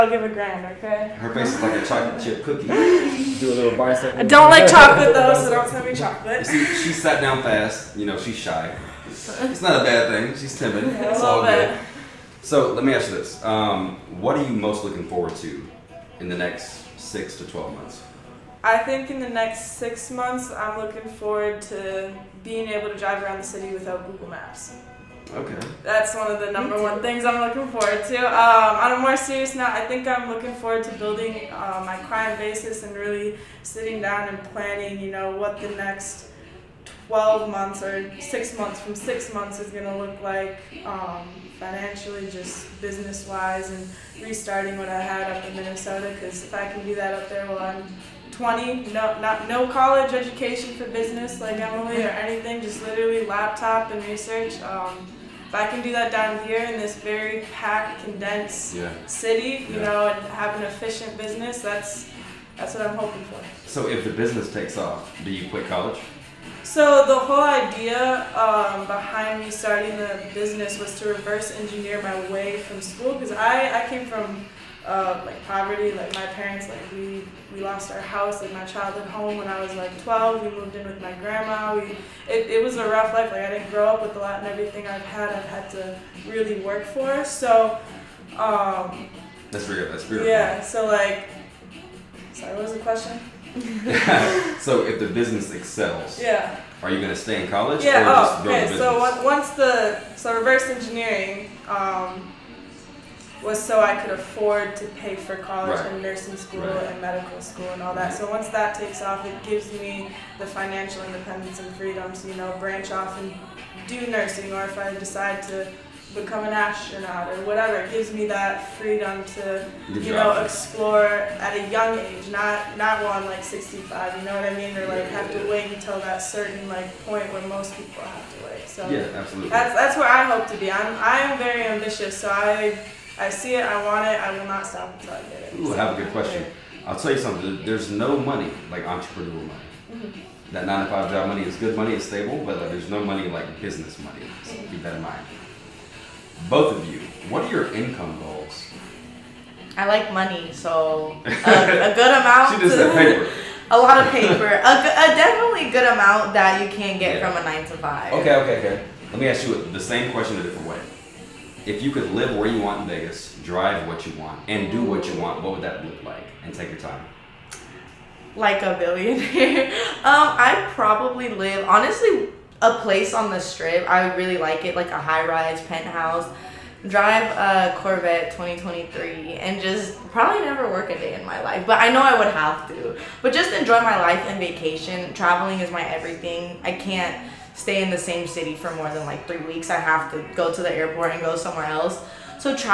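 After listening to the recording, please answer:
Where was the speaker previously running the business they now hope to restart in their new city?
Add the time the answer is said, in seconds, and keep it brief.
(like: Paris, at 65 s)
Minnesota, at 45 s.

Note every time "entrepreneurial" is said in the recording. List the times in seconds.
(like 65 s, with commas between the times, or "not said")
138 s.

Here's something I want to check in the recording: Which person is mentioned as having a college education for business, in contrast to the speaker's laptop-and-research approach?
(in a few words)
Emily.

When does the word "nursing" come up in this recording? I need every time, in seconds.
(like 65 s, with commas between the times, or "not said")
106 s, 114 s.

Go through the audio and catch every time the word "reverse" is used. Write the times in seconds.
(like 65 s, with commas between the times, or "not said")
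71 s, 100 s.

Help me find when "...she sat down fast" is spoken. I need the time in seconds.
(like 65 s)
6 s.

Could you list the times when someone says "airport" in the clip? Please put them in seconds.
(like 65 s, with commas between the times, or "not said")
190 s.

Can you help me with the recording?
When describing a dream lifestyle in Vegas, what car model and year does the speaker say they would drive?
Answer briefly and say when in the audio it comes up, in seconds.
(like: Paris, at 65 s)
Corvette 2023, at 177 s.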